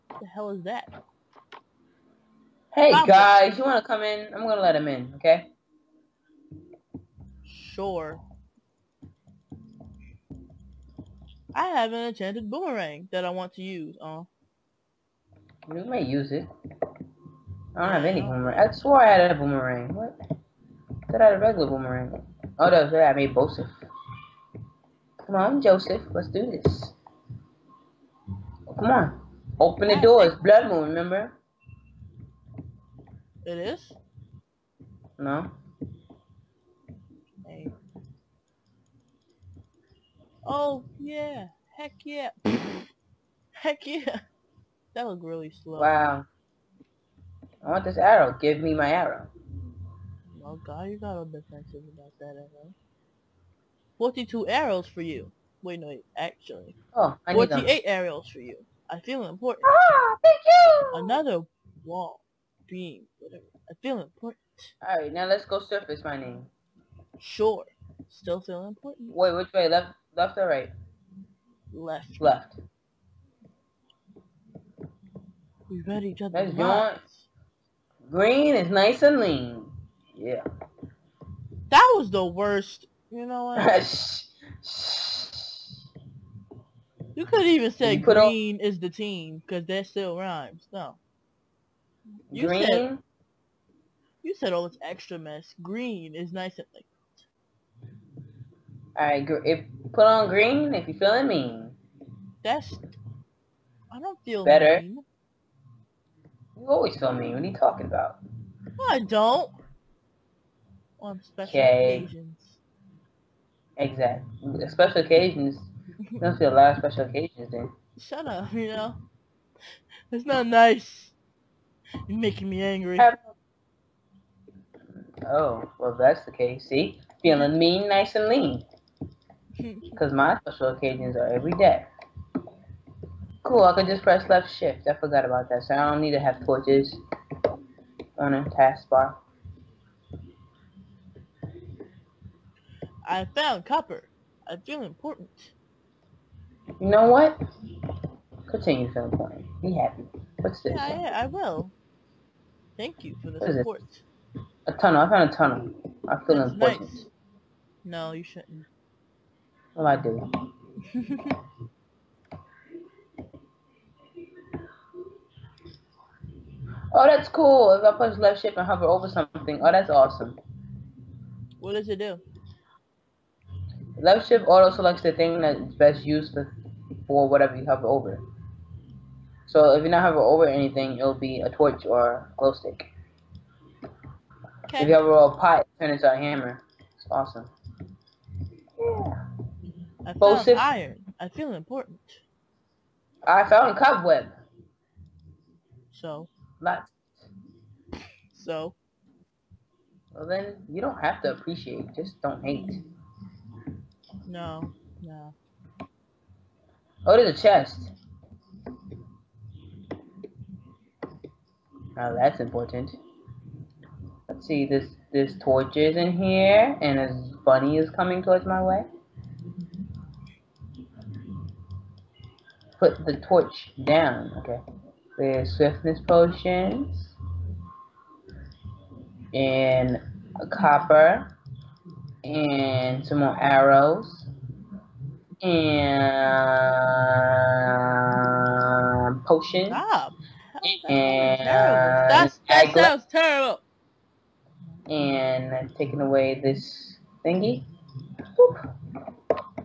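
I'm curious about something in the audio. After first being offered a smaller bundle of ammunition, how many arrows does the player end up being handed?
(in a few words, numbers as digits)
48.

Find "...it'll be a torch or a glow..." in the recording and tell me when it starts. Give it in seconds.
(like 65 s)
180 s.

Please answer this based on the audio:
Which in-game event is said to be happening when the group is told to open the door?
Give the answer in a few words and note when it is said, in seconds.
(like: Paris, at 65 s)
Blood Moon, at 30 s.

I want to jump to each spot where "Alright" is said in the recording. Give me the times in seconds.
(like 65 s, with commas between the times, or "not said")
64 s.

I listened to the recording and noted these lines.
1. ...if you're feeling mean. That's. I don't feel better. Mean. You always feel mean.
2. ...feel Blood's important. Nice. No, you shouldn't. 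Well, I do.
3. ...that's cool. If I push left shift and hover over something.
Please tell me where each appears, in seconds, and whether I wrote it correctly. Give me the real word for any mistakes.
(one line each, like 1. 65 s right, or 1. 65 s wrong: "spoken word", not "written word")
1. 100 s right
2. 156 s wrong: "That", not "Blood"
3. 167 s right.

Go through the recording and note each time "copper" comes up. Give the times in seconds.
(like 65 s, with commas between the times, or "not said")
143 s, 230 s.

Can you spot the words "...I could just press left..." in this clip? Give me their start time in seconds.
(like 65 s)
133 s.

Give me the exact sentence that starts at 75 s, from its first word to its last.
We read each other's Green is nice and lean.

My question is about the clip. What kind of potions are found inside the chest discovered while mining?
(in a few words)
Swiftness potions.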